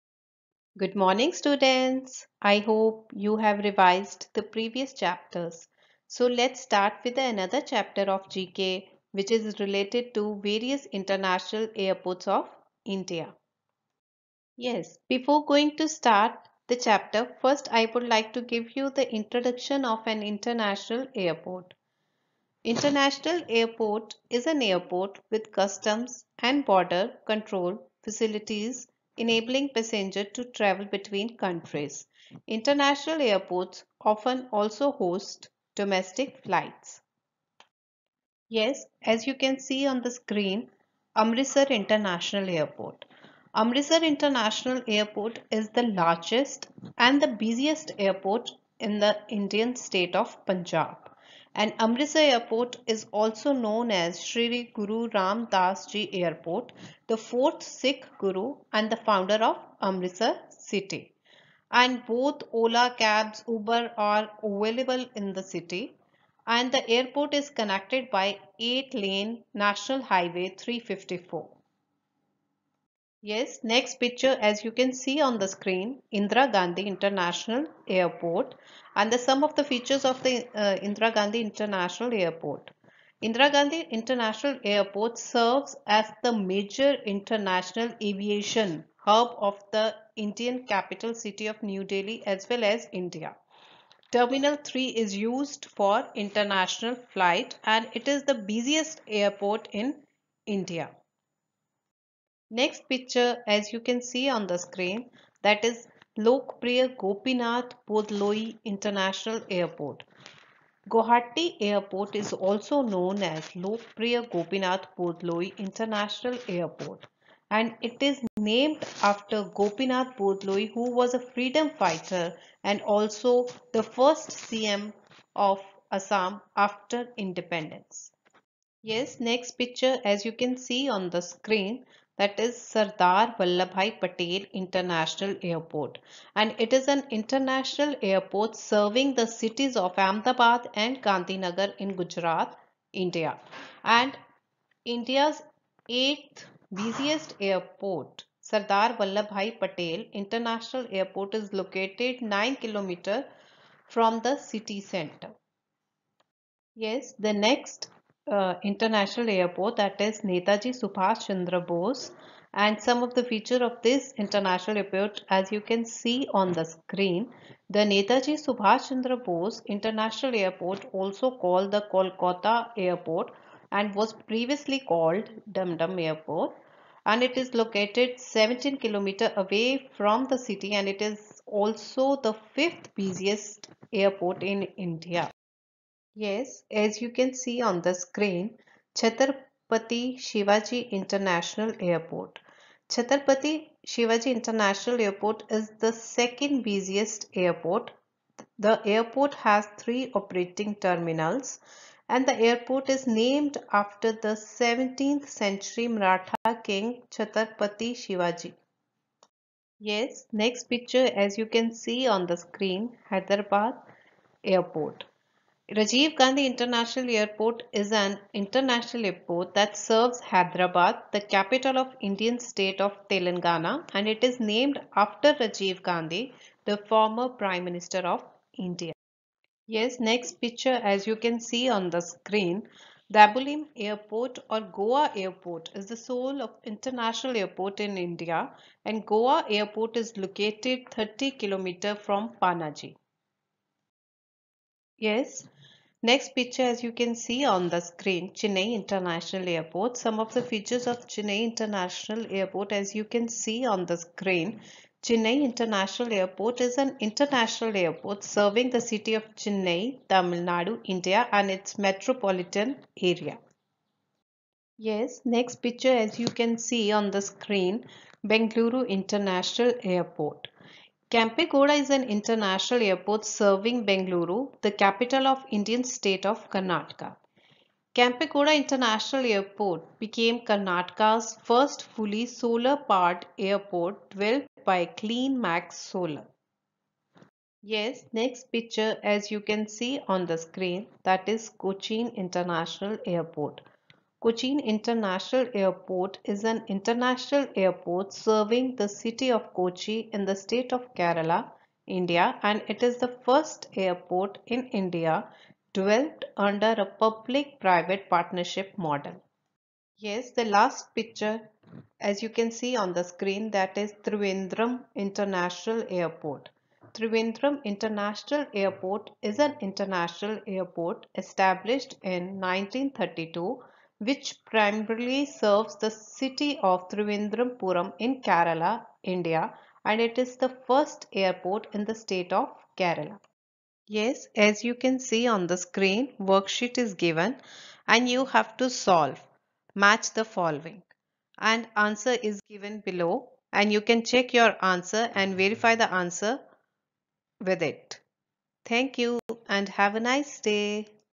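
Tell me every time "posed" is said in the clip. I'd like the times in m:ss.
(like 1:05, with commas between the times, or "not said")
not said.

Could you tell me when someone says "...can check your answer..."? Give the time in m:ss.
5:43.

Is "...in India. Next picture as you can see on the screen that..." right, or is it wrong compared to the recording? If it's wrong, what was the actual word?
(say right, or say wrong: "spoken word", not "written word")
right.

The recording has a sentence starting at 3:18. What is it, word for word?
The airport has three operating terminals and the airport is named after the 17th century Maratha king Chhatrapati Shivaji.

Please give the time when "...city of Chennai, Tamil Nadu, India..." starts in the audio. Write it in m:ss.
4:18.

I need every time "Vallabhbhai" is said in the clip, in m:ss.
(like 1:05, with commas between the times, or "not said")
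2:13, 2:29.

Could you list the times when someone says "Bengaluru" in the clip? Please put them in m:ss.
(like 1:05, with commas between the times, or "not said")
4:28, 4:33.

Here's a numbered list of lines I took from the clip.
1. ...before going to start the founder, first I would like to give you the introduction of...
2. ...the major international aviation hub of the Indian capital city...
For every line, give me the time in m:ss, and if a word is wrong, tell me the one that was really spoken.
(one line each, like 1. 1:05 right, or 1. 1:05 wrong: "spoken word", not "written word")
1. 0:15 wrong: "chapter", not "founder"
2. 1:26 right.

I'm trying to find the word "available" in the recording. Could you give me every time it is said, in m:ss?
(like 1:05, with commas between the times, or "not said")
1:04.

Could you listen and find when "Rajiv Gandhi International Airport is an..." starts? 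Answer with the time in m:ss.
3:35.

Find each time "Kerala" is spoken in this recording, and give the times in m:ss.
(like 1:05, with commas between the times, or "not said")
5:00, 5:28, 5:32.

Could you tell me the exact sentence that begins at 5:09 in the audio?
Yes, the last picture as you can see on the screen that is Trivandrum International Airport.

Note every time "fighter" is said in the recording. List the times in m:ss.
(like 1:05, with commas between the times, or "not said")
2:01.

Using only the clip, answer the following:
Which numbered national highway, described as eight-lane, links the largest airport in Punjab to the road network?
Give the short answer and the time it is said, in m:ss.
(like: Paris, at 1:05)
National Highway 354, at 1:09.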